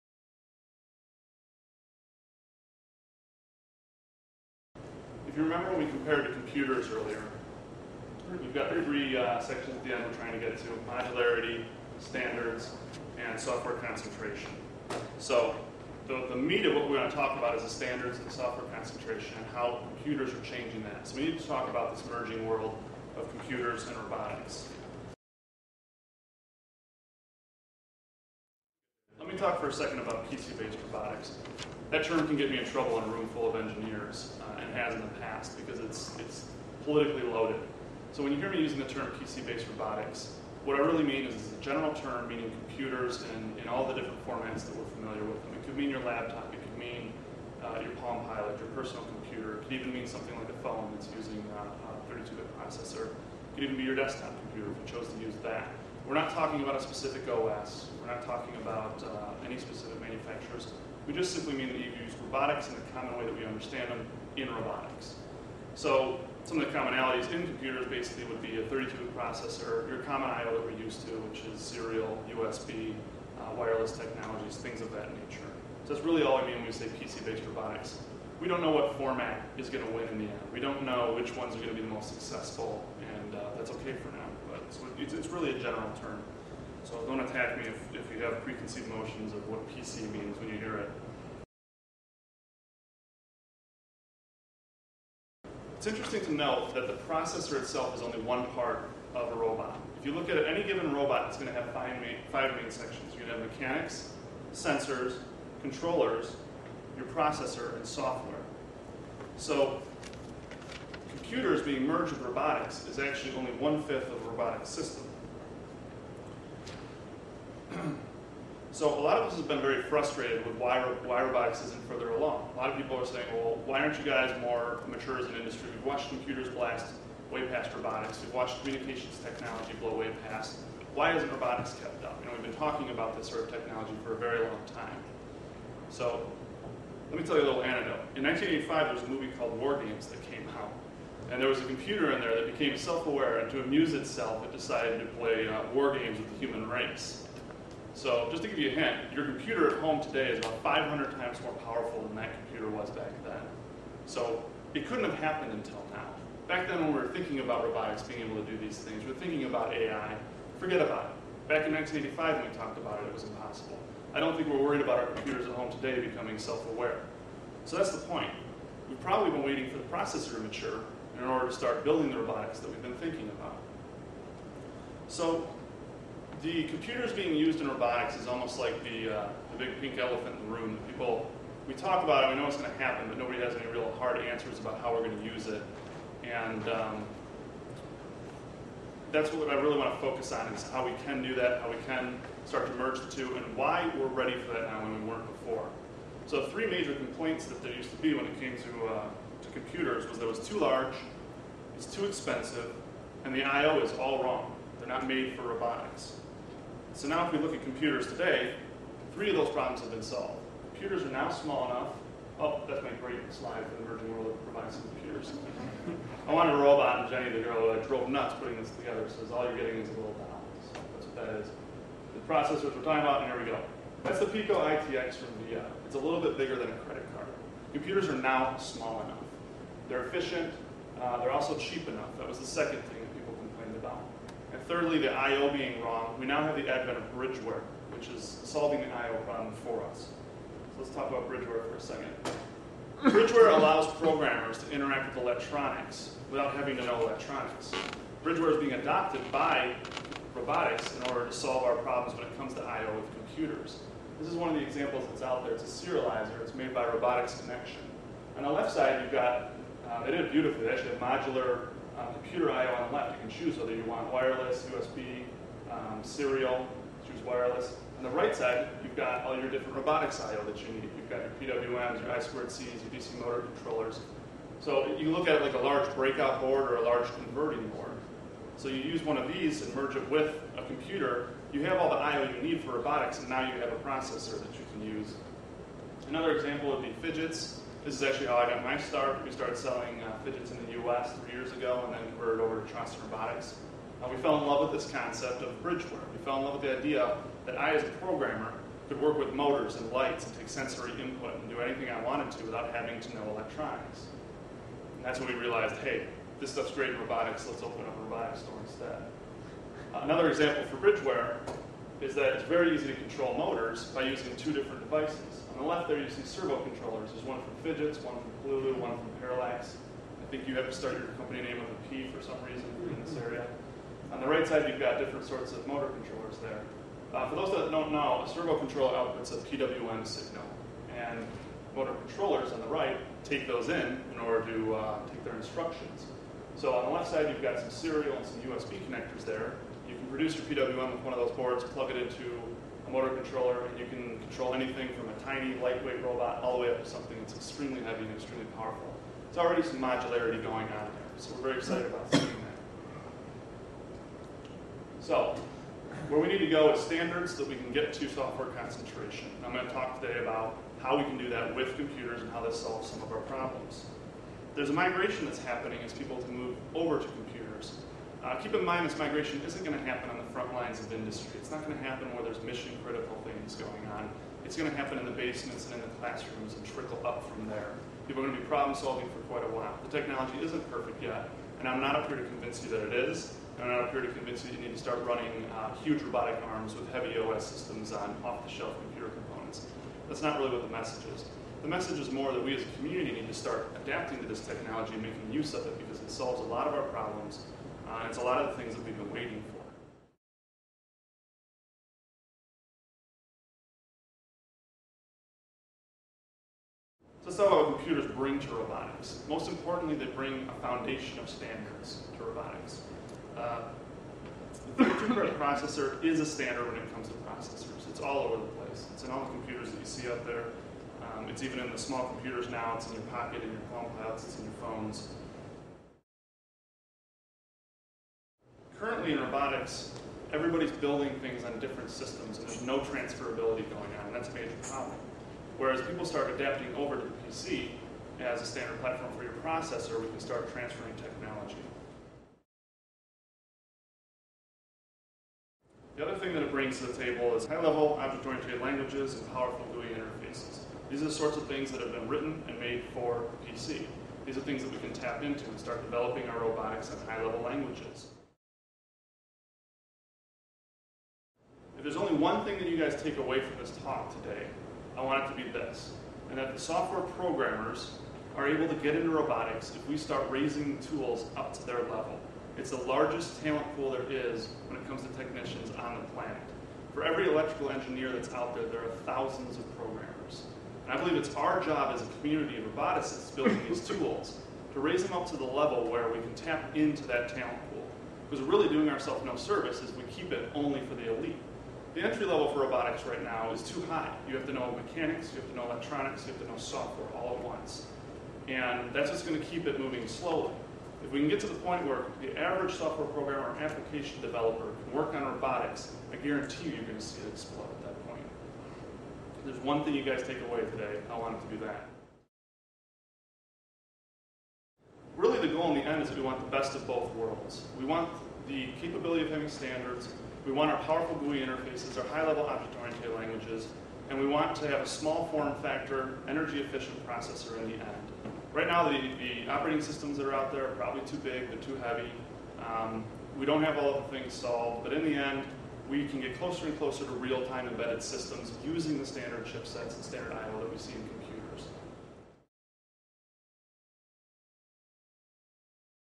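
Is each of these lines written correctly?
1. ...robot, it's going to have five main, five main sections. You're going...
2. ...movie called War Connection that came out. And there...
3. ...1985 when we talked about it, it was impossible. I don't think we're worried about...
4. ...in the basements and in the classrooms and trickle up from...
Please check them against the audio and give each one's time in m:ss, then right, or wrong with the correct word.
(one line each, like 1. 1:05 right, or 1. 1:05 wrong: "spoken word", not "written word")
1. 1:40 right
2. 2:19 wrong: "Games", not "Connection"
3. 2:41 right
4. 6:14 right.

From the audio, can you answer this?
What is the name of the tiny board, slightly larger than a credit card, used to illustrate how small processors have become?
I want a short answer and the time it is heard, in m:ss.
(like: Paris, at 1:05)
Pico ITX, at 3:44.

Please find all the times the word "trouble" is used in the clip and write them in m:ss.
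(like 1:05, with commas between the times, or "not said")
0:32.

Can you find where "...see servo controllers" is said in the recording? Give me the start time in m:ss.
5:16.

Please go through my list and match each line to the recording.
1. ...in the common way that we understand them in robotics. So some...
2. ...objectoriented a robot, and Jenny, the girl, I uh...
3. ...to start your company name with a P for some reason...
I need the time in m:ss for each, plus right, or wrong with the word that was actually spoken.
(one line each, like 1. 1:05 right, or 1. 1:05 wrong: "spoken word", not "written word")
1. 1:02 right
2. 3:36 wrong: "wanted", not "objectoriented"
3. 5:20 right.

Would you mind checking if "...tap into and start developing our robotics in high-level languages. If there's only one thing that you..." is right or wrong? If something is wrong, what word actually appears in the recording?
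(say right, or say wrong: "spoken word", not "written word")
right.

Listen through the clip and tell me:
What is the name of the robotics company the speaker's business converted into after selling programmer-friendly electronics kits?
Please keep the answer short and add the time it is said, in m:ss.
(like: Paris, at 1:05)
Trossen Robotics, at 4:52.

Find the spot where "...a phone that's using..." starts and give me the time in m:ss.
0:50.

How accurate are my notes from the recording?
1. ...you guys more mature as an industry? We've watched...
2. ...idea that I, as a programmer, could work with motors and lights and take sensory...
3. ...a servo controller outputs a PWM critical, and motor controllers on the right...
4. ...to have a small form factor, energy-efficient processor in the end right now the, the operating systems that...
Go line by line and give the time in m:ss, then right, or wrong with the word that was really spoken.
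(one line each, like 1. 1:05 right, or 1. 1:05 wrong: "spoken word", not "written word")
1. 2:03 right
2. 4:56 right
3. 5:28 wrong: "signal", not "critical"
4. 8:44 right.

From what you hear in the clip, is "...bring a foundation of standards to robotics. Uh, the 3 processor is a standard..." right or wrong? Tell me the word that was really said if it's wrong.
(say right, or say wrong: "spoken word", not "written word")
right.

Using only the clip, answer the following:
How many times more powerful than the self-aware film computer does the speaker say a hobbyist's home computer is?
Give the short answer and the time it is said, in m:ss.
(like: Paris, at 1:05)
500, at 2:30.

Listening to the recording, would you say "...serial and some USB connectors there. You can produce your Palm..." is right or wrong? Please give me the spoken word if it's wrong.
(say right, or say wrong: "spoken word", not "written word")
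wrong: "PWM", not "Palm".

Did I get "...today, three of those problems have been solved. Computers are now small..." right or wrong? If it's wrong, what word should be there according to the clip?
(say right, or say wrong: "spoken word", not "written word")
right.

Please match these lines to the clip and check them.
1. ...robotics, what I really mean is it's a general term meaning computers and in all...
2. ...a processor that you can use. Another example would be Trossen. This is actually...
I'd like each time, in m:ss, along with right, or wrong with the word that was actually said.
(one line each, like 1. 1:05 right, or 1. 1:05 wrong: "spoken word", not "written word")
1. 0:39 right
2. 4:43 wrong: "Phidgets", not "Trossen".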